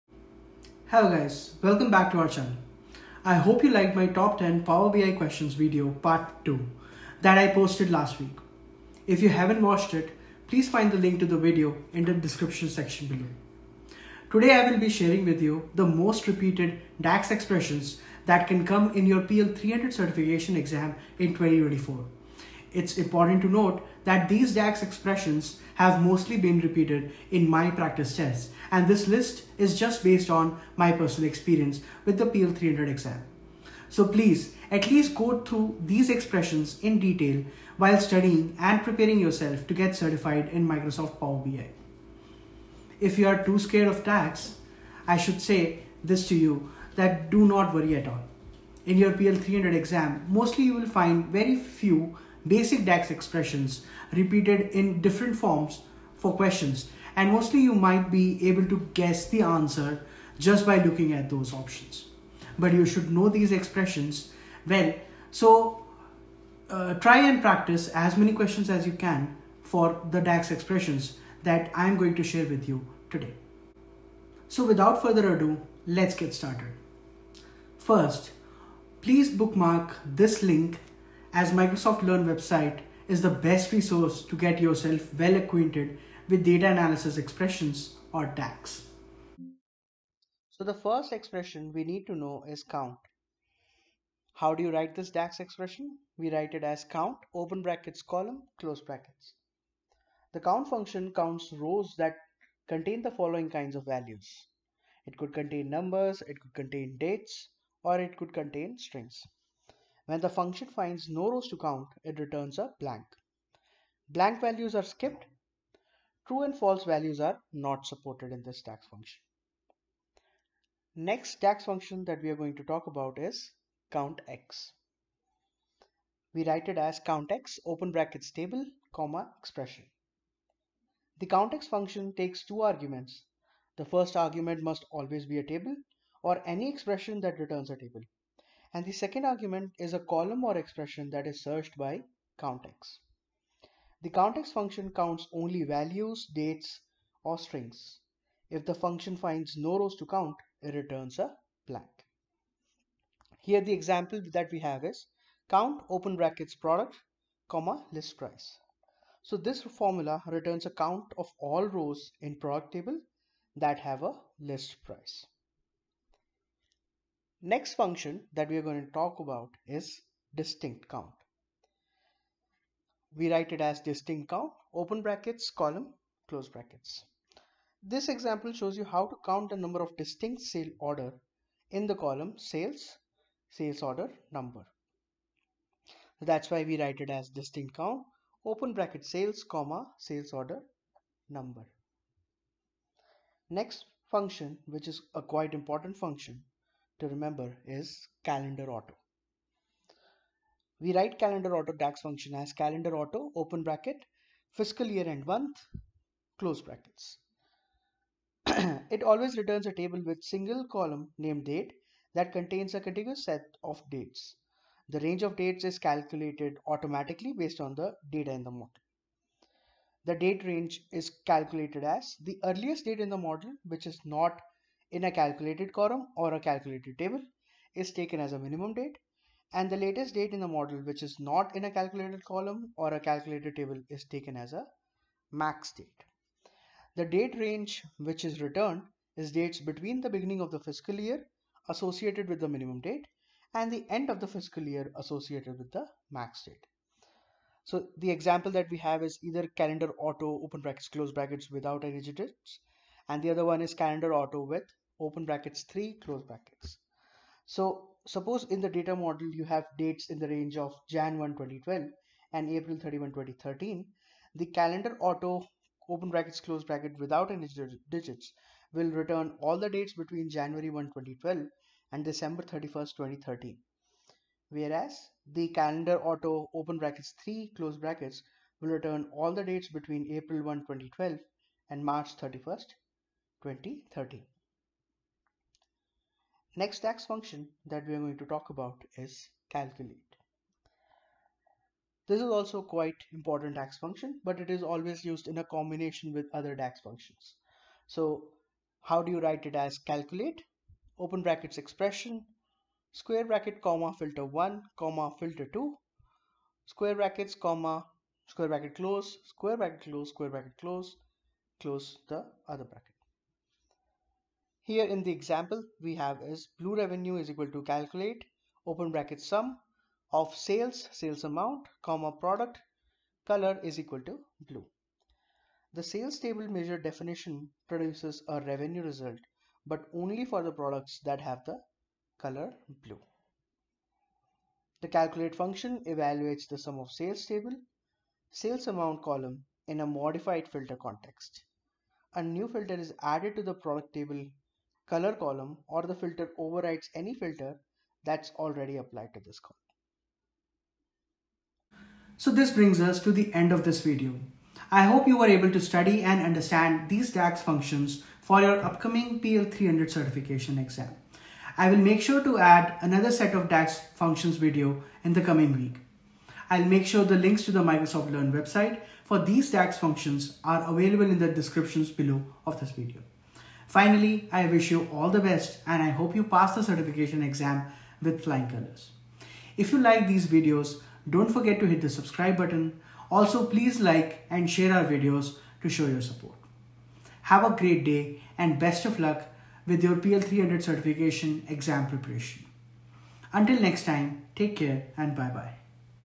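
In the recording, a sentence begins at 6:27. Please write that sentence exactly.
Have a great day and best of luck with your PL300 certification exam preparation.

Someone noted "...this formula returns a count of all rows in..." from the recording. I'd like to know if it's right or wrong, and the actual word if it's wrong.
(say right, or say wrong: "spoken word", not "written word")
right.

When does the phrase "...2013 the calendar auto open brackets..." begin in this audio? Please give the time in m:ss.
4:23.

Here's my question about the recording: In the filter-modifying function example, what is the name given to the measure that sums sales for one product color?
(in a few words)
blue revenue.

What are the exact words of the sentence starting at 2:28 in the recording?
If the function finds no rows to count, it returns a blank.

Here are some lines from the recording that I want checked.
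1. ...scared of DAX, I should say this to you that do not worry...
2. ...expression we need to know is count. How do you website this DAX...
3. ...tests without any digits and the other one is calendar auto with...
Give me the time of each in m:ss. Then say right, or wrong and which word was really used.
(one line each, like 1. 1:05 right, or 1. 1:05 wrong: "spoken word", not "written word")
1. 0:43 right
2. 1:31 wrong: "write", not "website"
3. 4:11 wrong: "brackets", not "tests".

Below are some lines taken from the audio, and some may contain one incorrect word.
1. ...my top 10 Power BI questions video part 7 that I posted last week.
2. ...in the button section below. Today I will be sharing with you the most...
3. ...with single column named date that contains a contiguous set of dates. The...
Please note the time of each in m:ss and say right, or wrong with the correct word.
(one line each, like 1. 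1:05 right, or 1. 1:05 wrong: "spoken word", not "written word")
1. 0:03 wrong: "2", not "7"
2. 0:11 wrong: "description", not "button"
3. 3:30 right.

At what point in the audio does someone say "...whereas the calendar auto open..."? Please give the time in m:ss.
4:34.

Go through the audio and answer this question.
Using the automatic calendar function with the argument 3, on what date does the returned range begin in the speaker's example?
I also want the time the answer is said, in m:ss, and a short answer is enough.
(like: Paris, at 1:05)
April 1 2012, at 4:40.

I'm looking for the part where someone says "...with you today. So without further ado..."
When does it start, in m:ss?
1:12.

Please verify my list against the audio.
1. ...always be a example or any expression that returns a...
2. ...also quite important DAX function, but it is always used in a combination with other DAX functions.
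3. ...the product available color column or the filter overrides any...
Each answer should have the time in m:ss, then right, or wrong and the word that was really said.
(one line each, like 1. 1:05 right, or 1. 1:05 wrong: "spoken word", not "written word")
1. 2:14 wrong: "table", not "example"
2. 4:52 right
3. 5:43 wrong: "table", not "available".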